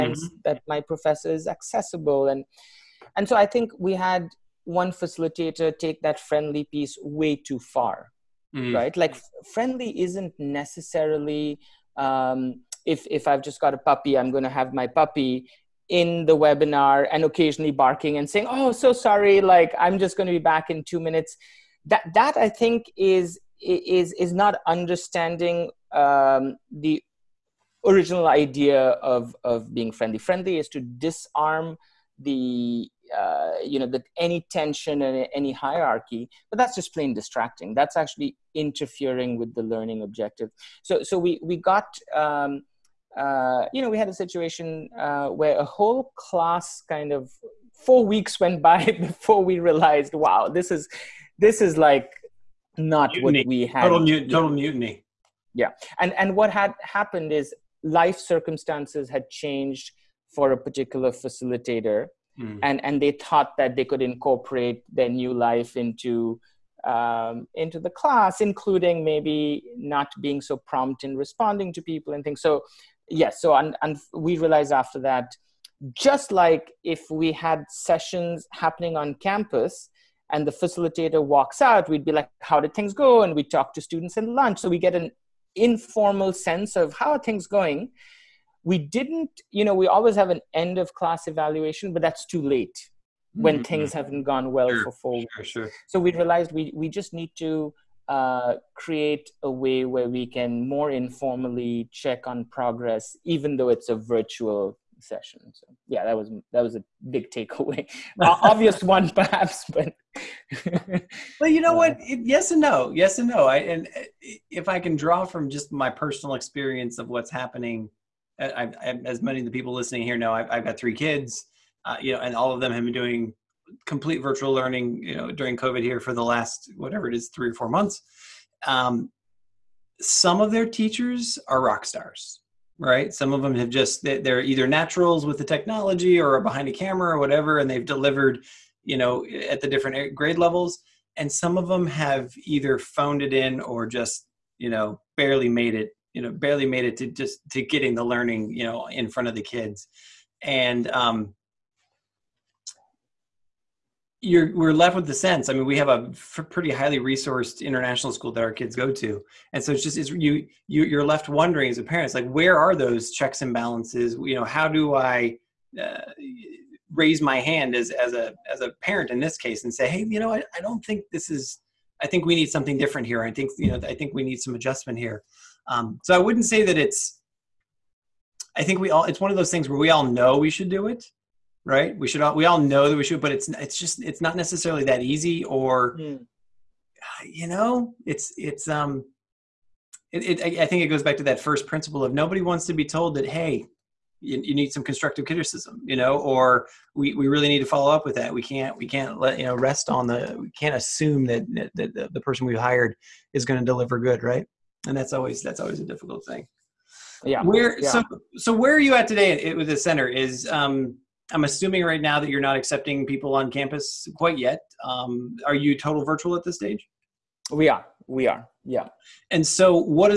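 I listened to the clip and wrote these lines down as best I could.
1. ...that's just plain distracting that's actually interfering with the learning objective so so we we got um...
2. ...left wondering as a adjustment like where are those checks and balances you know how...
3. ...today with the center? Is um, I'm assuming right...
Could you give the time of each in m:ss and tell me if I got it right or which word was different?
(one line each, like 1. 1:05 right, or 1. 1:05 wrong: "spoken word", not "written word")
1. 0:36 right
2. 2:41 wrong: "parent", not "adjustment"
3. 3:29 right.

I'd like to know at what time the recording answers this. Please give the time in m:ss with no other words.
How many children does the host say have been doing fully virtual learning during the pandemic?
2:00.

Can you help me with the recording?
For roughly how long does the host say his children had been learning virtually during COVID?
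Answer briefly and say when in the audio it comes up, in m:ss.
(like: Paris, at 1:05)
3 or 4 months, at 2:07.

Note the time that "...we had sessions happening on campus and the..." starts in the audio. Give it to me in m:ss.
1:17.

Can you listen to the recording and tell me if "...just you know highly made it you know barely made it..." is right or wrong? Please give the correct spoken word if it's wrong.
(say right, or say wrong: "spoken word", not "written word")
wrong: "barely", not "highly".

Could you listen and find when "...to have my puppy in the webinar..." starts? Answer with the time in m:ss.
0:14.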